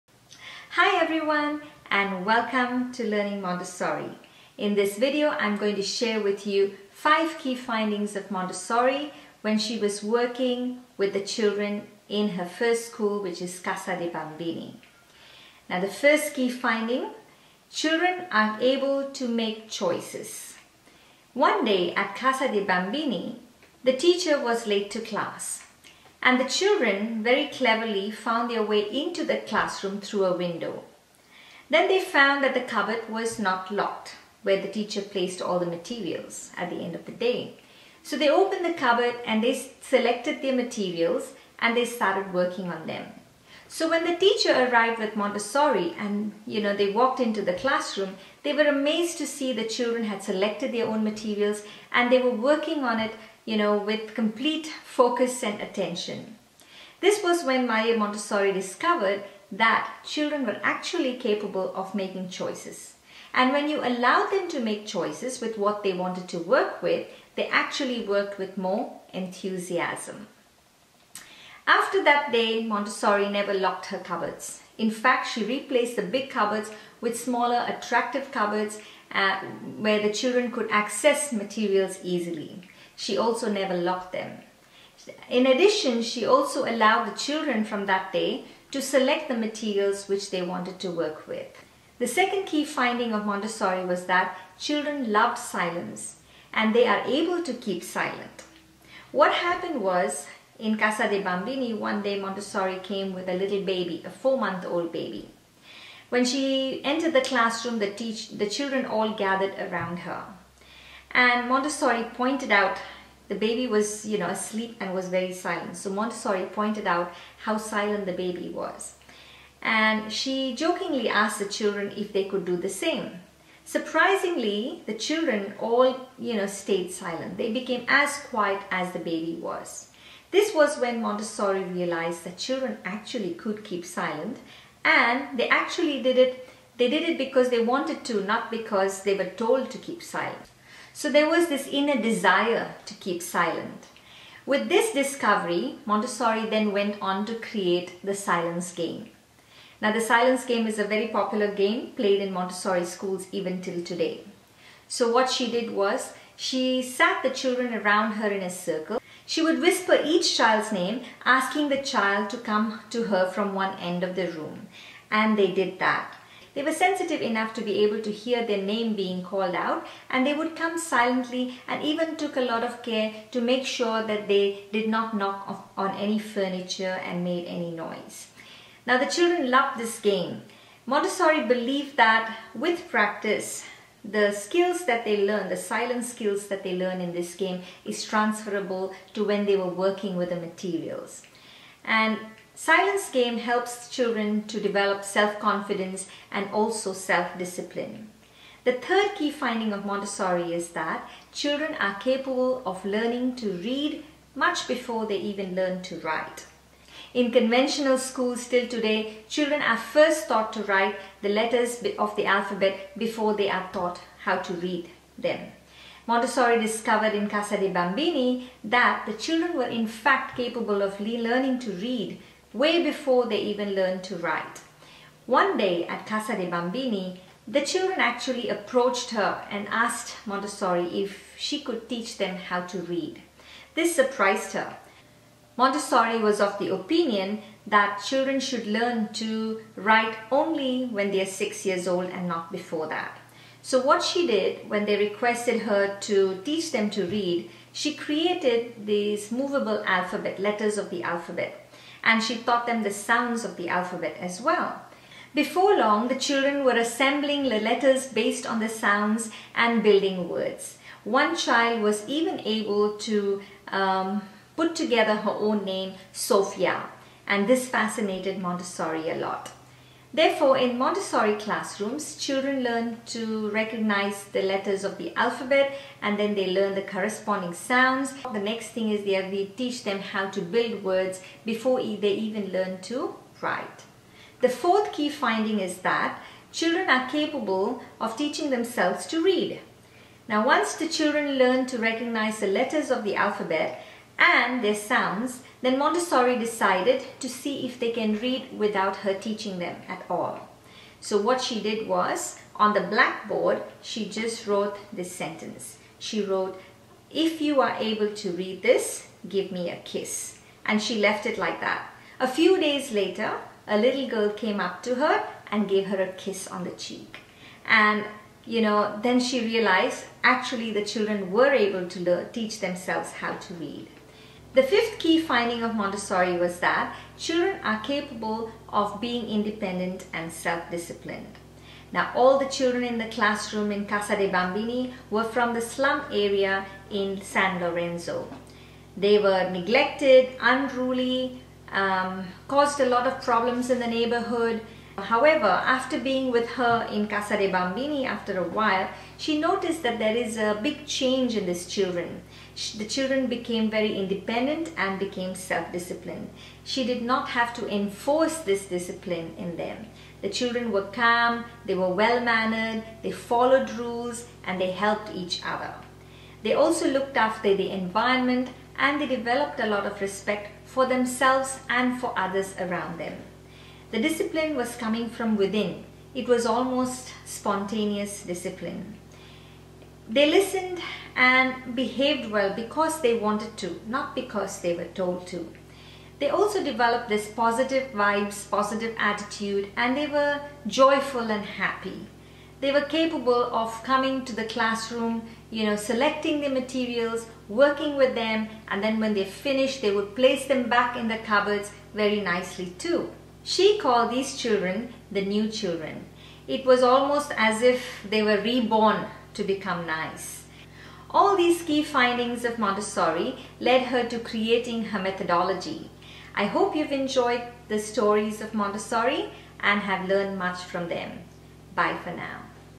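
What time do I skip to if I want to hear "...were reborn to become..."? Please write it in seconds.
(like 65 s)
408 s.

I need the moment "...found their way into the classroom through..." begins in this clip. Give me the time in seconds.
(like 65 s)
28 s.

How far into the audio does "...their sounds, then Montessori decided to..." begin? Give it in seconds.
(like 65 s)
294 s.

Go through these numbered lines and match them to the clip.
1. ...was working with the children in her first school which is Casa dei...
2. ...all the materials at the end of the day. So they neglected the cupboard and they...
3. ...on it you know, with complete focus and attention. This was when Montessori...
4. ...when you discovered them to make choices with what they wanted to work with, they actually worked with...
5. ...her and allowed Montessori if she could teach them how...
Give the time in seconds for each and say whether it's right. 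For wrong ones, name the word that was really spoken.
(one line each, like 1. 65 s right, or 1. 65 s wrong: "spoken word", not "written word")
1. 9 s right
2. 35 s wrong: "opened", not "neglected"
3. 52 s wrong: "Maria", not "Montessori"
4. 63 s wrong: "allowed", not "discovered"
5. 229 s wrong: "asked", not "allowed".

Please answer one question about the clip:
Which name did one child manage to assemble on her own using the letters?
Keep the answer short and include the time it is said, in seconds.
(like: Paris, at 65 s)
Sophia, at 266 s.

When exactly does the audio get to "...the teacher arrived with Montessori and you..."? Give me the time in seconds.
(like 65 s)
44 s.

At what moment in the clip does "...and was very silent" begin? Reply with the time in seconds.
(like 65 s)
114 s.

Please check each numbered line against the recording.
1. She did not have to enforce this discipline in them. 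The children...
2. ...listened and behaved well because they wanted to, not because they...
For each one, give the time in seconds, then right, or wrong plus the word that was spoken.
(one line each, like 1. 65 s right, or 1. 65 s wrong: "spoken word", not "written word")
1. 356 s right
2. 380 s right.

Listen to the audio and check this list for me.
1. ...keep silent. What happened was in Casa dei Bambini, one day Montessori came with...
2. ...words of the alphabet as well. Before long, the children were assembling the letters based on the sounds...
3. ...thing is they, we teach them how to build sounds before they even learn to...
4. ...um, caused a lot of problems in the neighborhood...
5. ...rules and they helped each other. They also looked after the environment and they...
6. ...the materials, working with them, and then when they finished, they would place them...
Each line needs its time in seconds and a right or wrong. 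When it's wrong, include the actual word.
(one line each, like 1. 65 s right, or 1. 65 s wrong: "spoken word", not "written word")
1. 97 s right
2. 252 s wrong: "sounds", not "words"
3. 278 s wrong: "words", not "sounds"
4. 341 s right
5. 363 s right
6. 396 s right.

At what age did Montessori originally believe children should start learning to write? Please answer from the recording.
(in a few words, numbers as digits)
6.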